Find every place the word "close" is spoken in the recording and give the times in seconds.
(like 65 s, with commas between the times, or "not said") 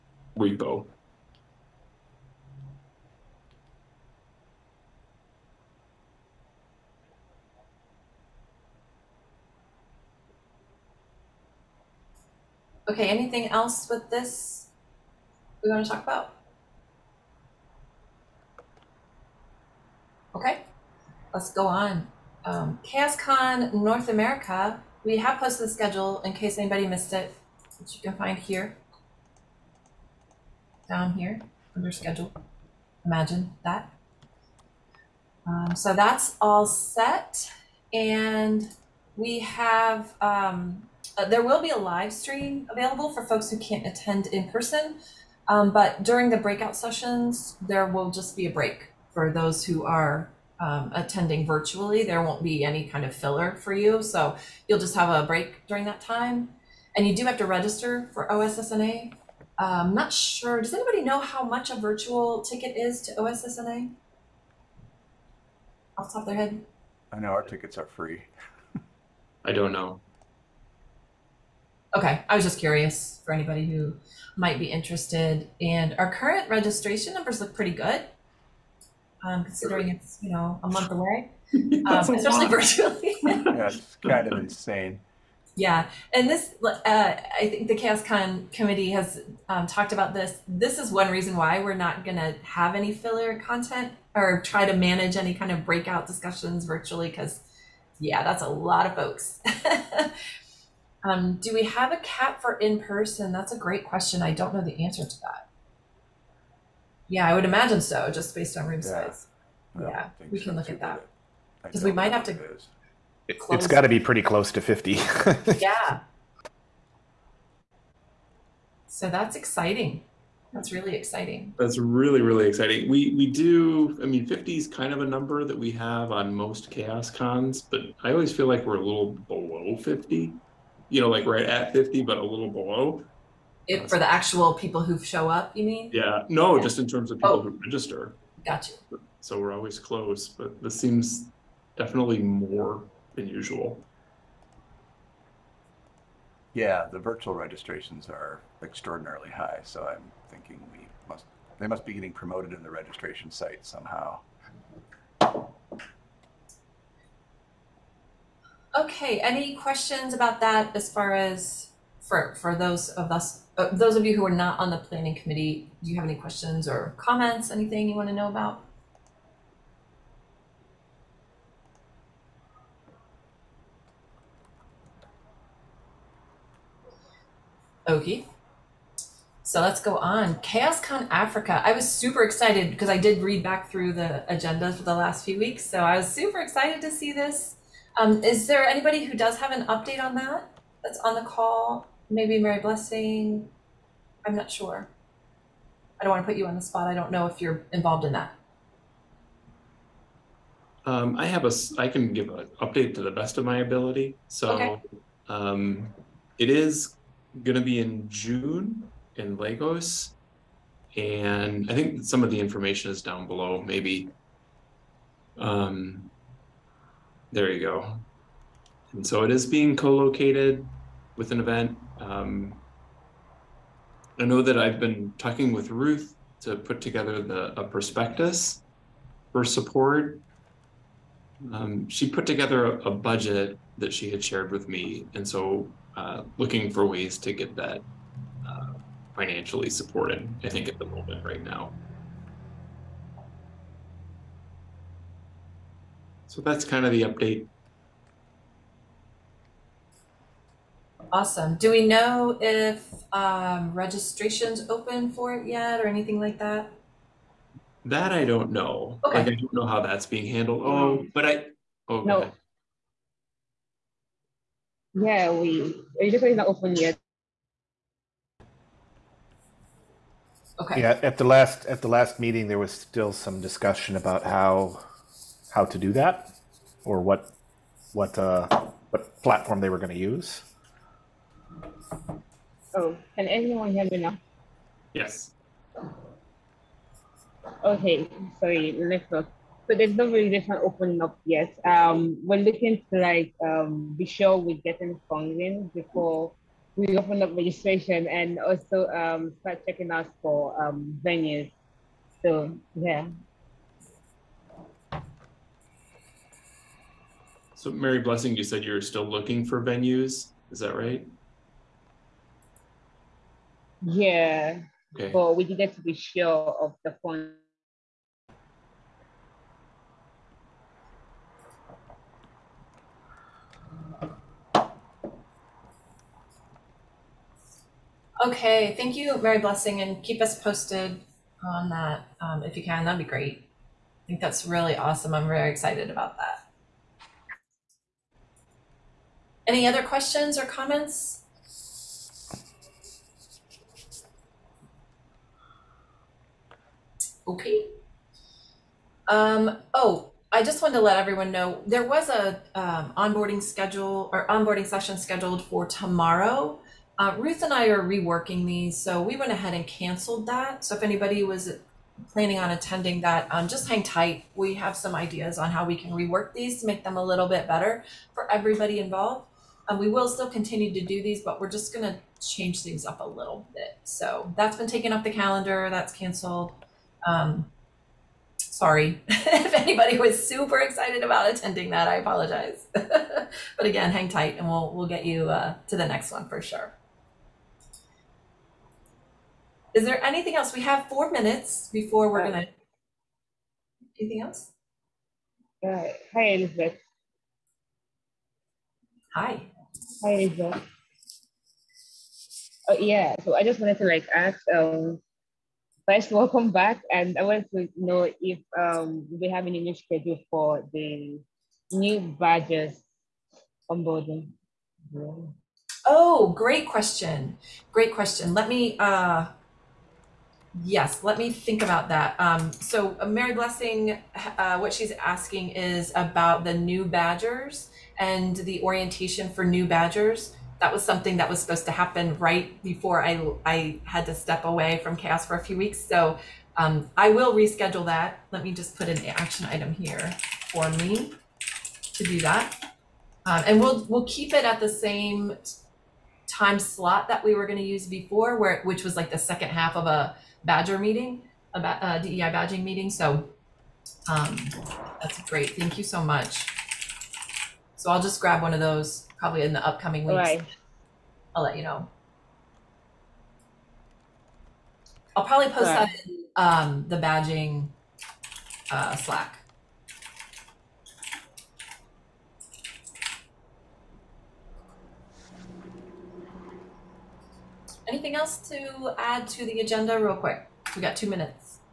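114 s, 139 s.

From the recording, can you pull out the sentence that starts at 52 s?
There won't be any kind of filler for you, so you'll just have a break during that time.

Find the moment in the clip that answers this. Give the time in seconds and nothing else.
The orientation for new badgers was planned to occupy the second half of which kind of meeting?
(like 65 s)
451 s.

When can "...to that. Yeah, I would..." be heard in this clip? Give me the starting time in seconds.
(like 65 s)
105 s.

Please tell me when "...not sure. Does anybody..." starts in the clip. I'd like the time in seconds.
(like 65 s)
59 s.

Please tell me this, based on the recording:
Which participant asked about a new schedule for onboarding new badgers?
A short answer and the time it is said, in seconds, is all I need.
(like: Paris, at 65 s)
Rizal, at 400 s.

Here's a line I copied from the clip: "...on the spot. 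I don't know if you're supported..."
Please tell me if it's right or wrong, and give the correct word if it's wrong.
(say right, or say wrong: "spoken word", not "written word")
wrong: "involved", not "supported".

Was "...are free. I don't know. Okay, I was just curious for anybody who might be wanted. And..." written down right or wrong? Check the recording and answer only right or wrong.
wrong.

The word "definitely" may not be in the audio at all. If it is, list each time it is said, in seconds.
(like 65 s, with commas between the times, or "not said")
141 s.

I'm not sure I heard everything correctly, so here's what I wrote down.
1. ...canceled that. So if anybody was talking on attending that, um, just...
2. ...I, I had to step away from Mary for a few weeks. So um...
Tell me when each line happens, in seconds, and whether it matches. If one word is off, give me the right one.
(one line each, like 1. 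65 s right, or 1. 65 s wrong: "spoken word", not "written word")
1. 359 s wrong: "planning", not "talking"
2. 433 s wrong: "CHAOSS", not "Mary".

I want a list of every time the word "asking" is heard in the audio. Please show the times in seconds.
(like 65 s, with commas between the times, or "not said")
424 s.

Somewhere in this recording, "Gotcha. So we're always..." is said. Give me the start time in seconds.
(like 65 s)
138 s.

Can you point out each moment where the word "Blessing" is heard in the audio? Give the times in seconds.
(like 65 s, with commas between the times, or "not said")
192 s, 307 s, 329 s, 423 s.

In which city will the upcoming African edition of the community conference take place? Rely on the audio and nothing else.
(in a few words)
Lagos.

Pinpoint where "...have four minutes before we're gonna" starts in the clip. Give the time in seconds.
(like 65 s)
390 s.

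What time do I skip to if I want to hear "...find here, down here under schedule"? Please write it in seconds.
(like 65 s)
28 s.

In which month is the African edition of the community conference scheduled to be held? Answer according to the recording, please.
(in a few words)
June.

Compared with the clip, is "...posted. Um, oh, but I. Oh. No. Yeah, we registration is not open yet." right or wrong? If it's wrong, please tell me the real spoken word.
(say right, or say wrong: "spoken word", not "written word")
wrong: "handled", not "posted".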